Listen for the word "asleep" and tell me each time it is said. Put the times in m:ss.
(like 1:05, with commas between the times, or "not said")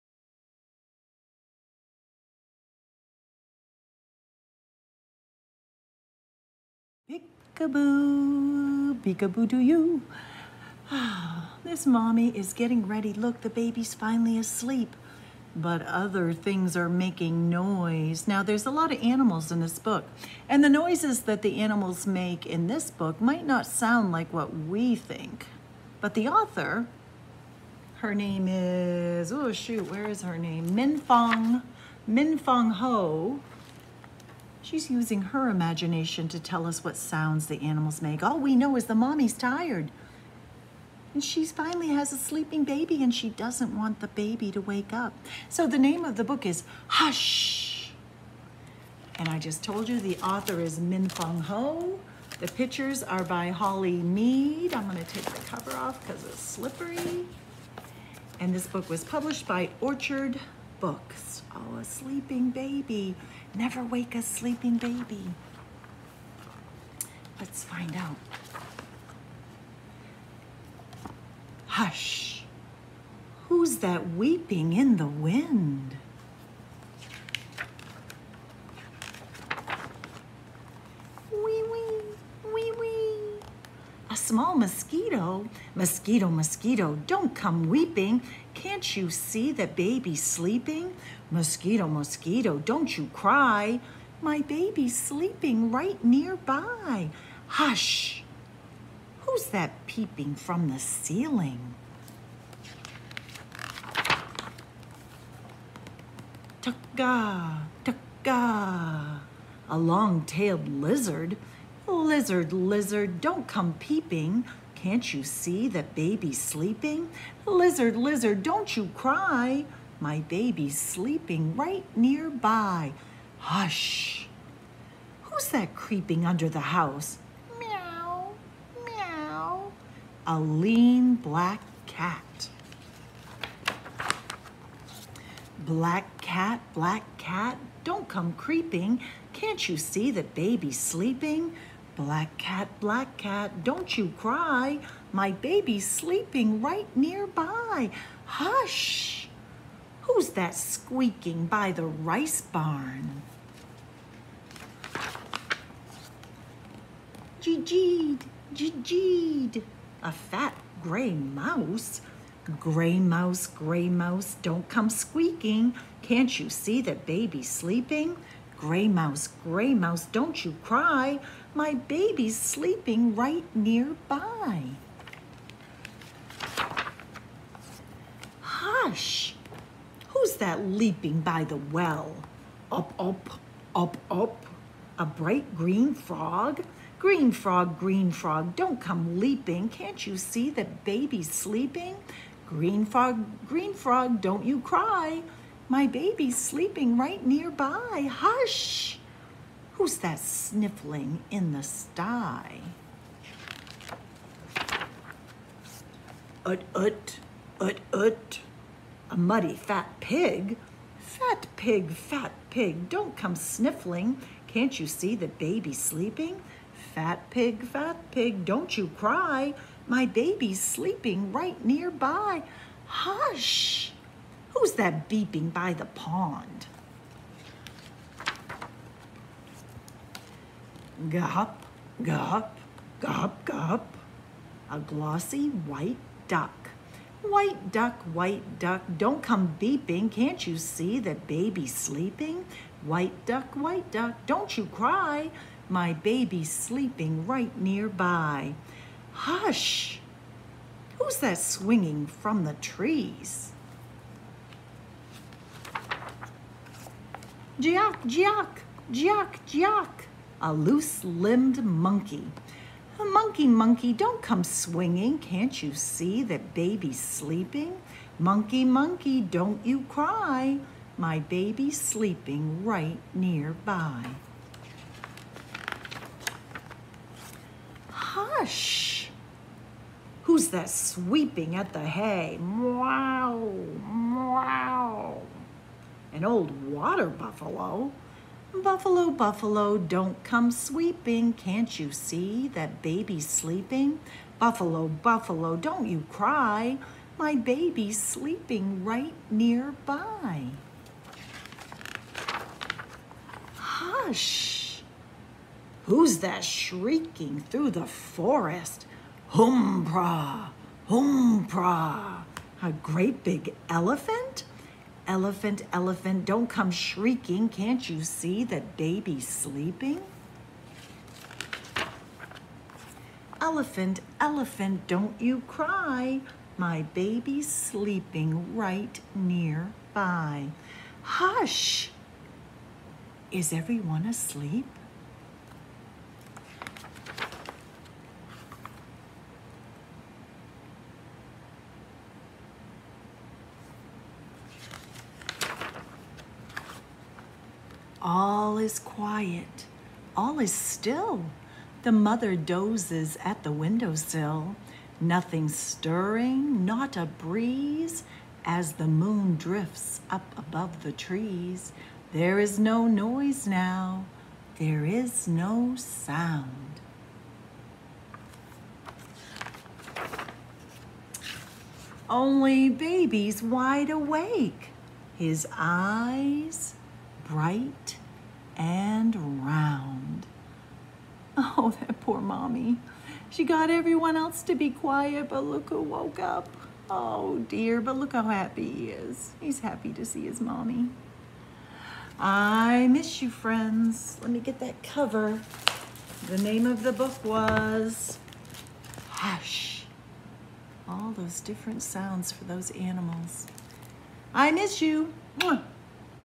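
0:14, 5:34.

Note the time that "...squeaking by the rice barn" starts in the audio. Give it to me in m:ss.
2:30.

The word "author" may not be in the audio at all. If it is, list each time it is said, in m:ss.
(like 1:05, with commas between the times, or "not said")
0:26, 0:50.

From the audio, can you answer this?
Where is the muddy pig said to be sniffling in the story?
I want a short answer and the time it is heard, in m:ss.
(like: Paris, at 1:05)
in the sty, at 3:21.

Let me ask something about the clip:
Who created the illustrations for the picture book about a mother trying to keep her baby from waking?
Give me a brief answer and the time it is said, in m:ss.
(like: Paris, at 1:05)
Holly Meade, at 0:53.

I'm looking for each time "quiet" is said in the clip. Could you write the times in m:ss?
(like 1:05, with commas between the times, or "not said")
5:48, 6:24.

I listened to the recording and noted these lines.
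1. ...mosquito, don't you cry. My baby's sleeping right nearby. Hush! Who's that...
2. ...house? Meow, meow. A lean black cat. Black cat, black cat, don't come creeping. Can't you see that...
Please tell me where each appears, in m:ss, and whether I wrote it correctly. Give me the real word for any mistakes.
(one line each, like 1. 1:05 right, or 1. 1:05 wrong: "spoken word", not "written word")
1. 1:31 right
2. 2:06 right.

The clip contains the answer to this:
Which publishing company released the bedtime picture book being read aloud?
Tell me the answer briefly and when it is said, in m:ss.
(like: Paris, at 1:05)
Orchard Books, at 0:59.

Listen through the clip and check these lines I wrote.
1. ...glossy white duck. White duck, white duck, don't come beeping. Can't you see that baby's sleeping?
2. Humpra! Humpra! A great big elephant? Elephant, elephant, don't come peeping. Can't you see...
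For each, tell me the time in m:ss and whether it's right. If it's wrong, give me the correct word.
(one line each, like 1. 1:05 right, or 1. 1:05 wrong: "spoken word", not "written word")
1. 3:54 right
2. 5:09 wrong: "shrieking", not "peeping".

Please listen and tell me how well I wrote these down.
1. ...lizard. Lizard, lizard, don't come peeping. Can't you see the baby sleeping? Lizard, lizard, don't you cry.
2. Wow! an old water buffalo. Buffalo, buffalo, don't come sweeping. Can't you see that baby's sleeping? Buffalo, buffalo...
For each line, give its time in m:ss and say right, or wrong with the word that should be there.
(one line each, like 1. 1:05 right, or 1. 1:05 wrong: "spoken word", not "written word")
1. 1:50 right
2. 4:43 right.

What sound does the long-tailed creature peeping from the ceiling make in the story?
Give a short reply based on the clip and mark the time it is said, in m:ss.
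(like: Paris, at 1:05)
Tukka, tukka, at 1:46.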